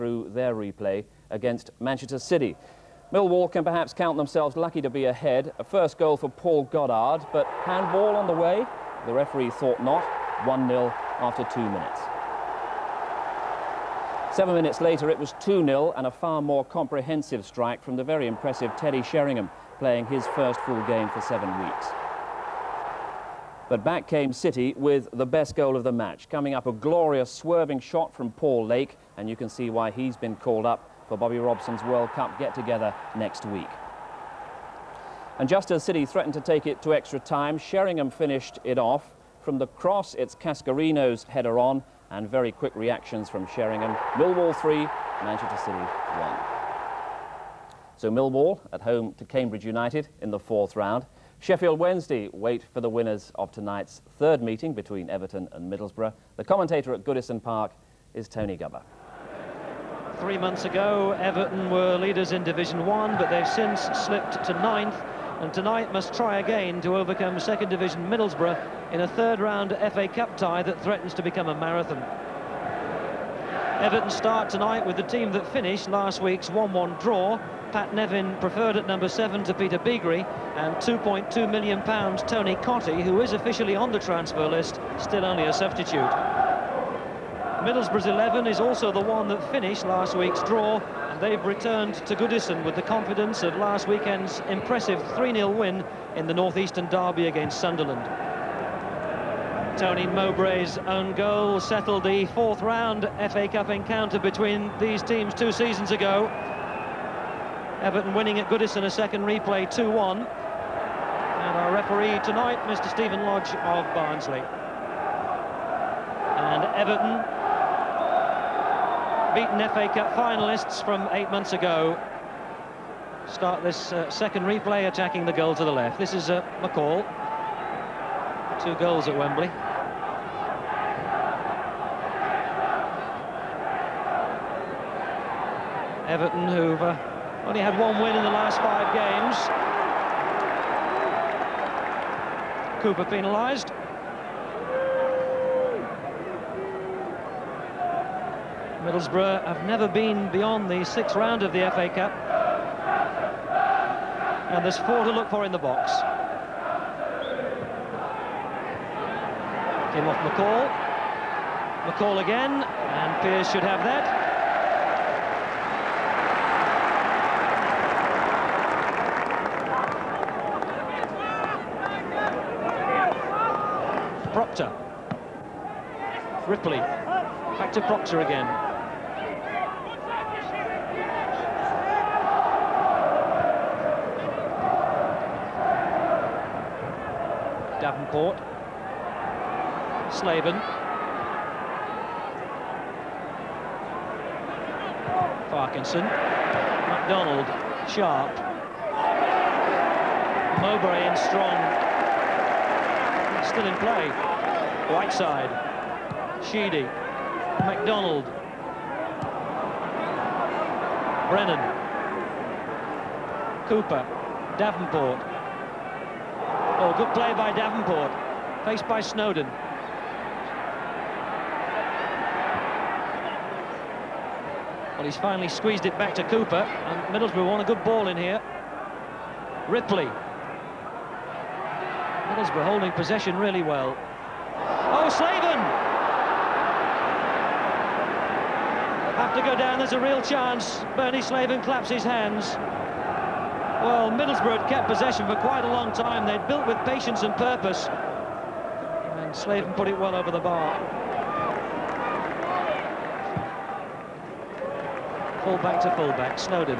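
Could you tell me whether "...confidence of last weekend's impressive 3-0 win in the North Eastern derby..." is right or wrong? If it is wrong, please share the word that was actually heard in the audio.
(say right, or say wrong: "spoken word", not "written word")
right.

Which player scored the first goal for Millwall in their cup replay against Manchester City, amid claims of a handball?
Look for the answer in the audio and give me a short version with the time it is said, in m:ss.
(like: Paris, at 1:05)
Paul Goddard, at 0:06.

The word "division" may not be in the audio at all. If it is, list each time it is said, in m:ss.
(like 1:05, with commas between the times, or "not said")
1:02, 1:07.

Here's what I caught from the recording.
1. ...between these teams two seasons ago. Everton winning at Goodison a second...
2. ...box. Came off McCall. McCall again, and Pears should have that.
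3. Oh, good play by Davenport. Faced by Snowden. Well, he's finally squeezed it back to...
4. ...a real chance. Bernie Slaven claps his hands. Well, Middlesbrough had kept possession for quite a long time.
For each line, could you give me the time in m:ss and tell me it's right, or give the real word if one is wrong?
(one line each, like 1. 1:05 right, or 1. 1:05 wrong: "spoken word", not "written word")
1. 1:44 right
2. 2:35 right
3. 3:36 right
4. 3:59 right.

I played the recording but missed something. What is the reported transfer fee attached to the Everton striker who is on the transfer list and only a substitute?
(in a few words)
2.2 million pounds.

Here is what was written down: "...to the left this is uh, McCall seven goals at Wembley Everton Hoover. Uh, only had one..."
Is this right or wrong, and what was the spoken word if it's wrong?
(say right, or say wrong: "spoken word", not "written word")
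wrong: "two", not "seven".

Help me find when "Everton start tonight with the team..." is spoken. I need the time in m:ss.
1:13.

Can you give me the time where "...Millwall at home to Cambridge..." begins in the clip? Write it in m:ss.
0:48.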